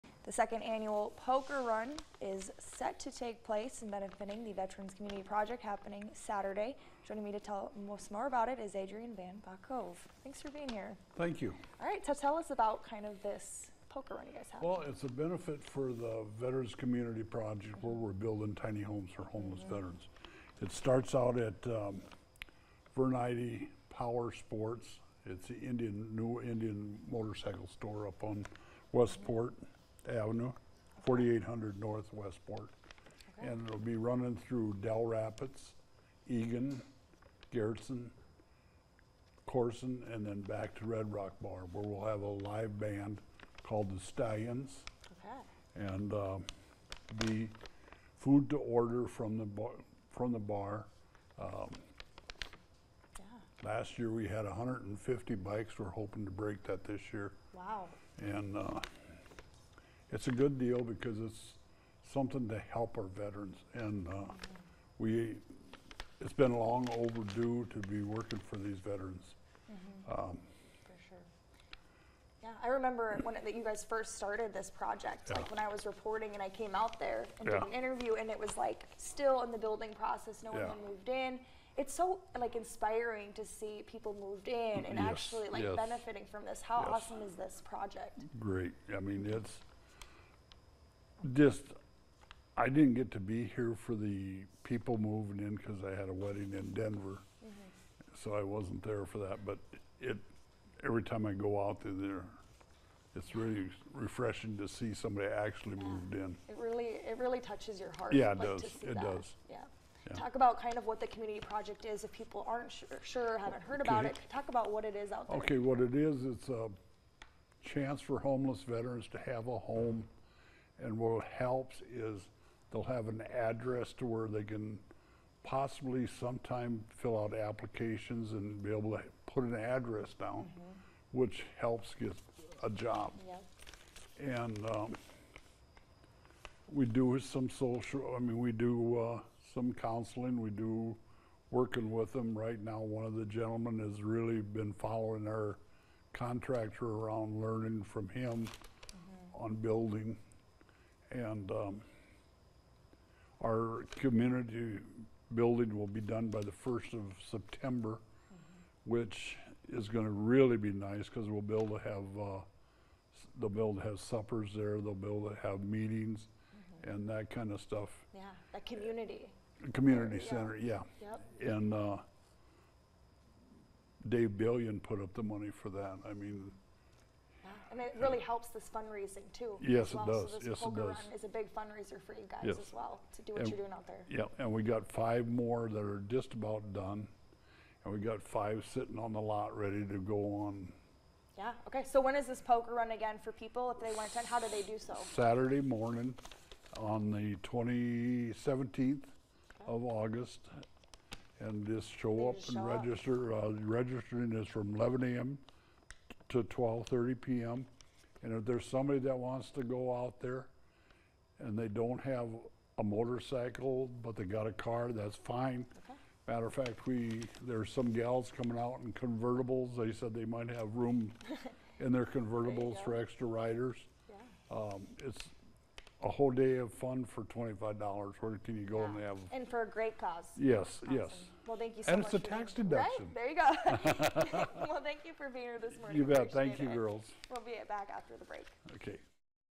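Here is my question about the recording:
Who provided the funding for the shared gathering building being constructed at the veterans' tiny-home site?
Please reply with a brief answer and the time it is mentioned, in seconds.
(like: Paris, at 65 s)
Dave Billion, at 174 s.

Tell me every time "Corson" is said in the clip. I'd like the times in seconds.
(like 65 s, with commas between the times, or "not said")
39 s.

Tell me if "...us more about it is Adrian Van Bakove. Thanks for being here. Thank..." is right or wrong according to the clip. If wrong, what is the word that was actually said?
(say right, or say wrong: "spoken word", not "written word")
right.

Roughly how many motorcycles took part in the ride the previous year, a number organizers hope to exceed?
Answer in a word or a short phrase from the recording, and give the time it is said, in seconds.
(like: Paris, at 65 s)
150, at 54 s.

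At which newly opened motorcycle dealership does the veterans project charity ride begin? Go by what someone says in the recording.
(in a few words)
Vernity Power Sports.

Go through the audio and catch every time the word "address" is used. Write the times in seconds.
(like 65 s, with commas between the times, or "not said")
123 s, 129 s.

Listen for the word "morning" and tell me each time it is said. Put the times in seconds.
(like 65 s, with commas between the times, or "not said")
195 s, 235 s.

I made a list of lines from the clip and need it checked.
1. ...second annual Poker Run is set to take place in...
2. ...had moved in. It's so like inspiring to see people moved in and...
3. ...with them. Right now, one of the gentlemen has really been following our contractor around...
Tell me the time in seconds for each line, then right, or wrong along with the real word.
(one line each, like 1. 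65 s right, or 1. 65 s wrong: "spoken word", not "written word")
1. 0 s right
2. 80 s right
3. 141 s right.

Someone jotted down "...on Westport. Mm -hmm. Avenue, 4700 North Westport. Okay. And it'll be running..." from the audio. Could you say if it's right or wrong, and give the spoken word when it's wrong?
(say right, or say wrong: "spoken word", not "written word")
wrong: "4800", not "4700".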